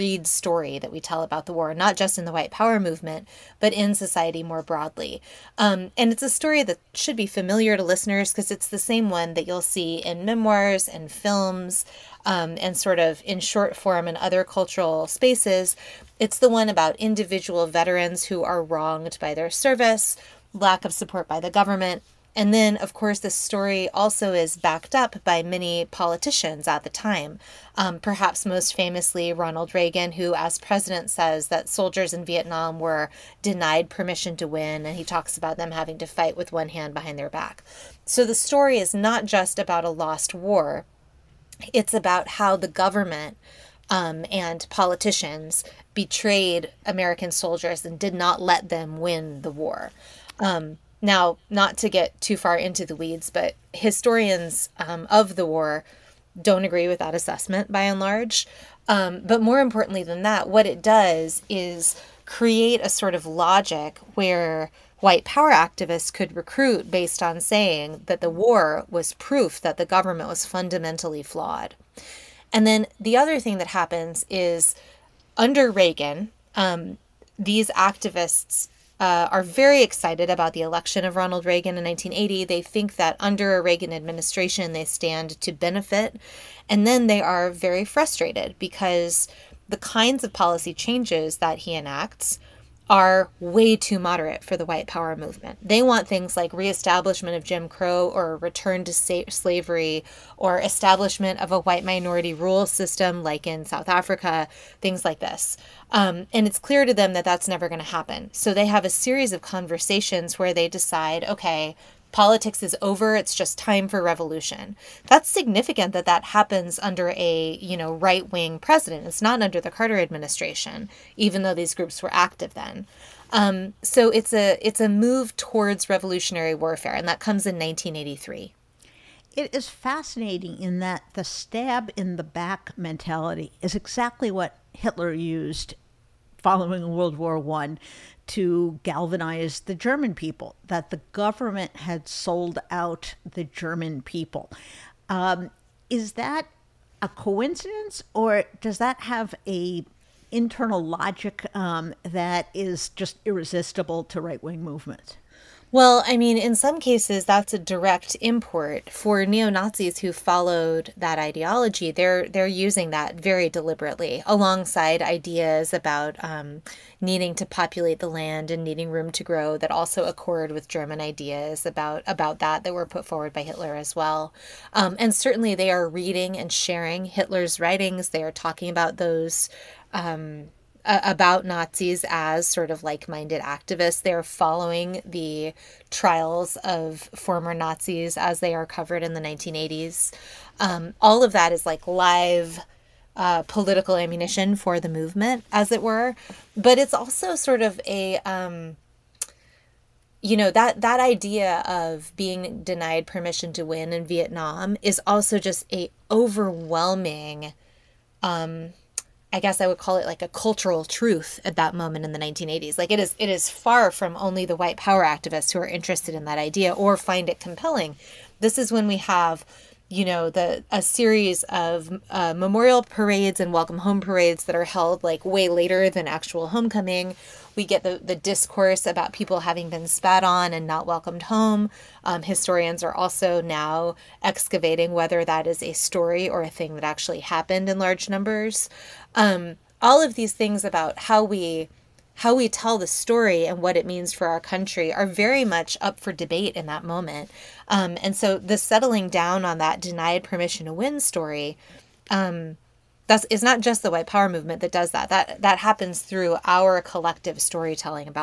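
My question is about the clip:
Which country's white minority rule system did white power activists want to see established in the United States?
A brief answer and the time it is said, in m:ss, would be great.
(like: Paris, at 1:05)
South Africa, at 1:43.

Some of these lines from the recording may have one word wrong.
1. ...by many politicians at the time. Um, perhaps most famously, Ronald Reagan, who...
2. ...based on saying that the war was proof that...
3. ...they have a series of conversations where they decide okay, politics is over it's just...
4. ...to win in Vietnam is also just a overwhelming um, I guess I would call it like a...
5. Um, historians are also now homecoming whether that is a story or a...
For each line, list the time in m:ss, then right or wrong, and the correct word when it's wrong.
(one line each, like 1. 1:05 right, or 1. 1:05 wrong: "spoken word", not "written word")
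1. 0:25 right
2. 1:06 right
3. 1:48 right
4. 3:23 right
5. 3:52 wrong: "excavating", not "homecoming".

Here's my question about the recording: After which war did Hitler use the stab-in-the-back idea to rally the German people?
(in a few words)
World War One.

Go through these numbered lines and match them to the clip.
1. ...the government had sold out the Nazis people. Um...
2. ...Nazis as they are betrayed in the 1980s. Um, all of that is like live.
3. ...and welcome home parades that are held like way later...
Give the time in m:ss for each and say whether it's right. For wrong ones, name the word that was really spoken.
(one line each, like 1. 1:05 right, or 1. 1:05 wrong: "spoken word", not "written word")
1. 2:20 wrong: "German", not "Nazis"
2. 3:07 wrong: "covered", not "betrayed"
3. 3:43 right.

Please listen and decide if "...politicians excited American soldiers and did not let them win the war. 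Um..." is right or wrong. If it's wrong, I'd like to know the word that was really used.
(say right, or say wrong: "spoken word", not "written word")
wrong: "betrayed", not "excited".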